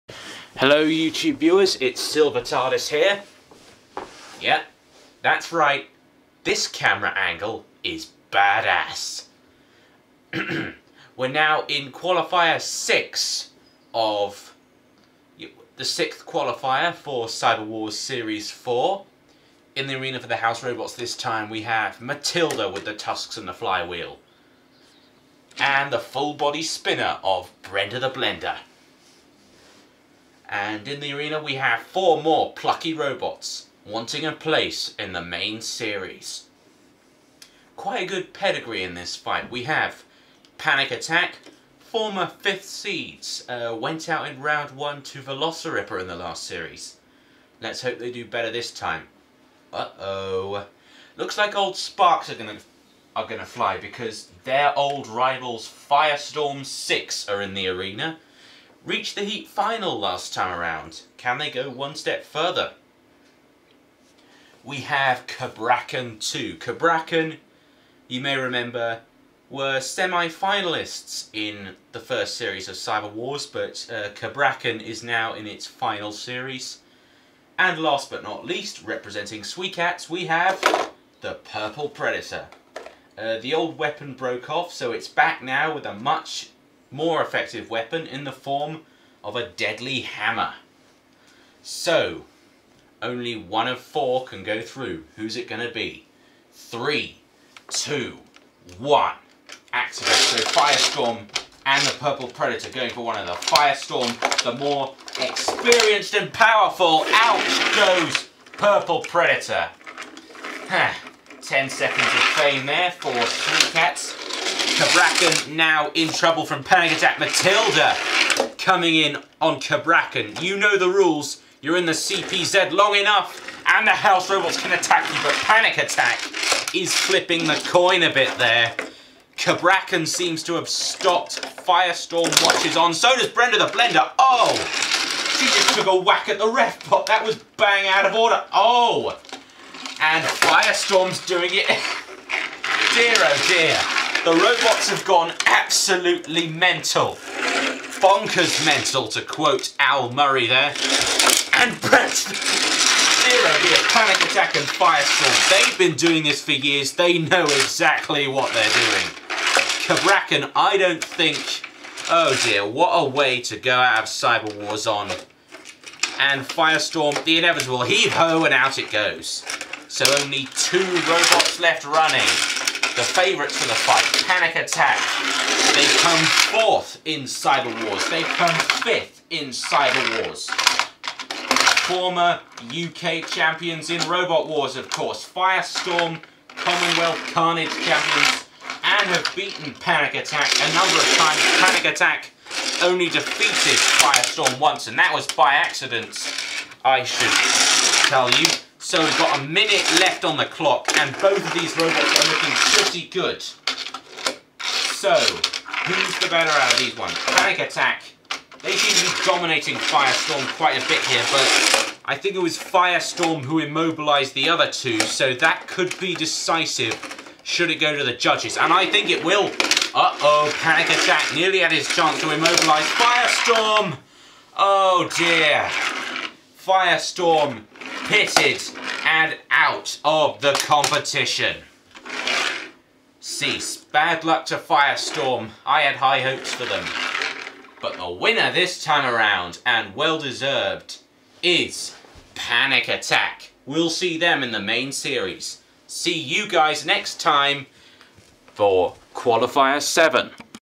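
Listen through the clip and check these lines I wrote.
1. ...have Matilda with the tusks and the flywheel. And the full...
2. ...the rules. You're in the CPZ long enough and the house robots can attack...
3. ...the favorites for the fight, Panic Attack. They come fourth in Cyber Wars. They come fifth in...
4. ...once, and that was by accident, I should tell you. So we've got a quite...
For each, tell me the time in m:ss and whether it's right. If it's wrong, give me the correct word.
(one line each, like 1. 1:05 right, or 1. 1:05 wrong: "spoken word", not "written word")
1. 0:21 right
2. 2:00 right
3. 2:52 right
4. 3:14 wrong: "minute", not "quite".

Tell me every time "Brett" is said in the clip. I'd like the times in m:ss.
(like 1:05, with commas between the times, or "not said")
2:31.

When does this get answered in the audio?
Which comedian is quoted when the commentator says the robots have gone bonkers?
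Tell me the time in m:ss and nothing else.
2:29.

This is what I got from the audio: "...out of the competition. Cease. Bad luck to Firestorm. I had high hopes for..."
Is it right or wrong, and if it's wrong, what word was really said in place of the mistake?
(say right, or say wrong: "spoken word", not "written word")
right.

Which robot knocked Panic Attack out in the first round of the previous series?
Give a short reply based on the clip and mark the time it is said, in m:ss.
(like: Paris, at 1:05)
Velociraptor, at 0:45.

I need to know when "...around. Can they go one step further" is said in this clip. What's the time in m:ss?
1:00.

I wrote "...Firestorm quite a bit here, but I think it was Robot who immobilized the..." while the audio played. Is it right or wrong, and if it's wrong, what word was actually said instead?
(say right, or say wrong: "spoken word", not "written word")
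wrong: "Firestorm", not "Robot".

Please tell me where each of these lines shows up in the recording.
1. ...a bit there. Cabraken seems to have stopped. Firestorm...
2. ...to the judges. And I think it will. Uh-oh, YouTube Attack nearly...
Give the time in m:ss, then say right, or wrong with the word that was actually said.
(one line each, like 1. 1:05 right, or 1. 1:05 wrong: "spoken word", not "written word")
1. 2:08 right
2. 3:37 wrong: "Panic", not "YouTube".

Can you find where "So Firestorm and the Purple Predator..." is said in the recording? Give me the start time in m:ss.
1:40.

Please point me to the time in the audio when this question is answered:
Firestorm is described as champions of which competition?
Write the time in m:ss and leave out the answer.
3:06.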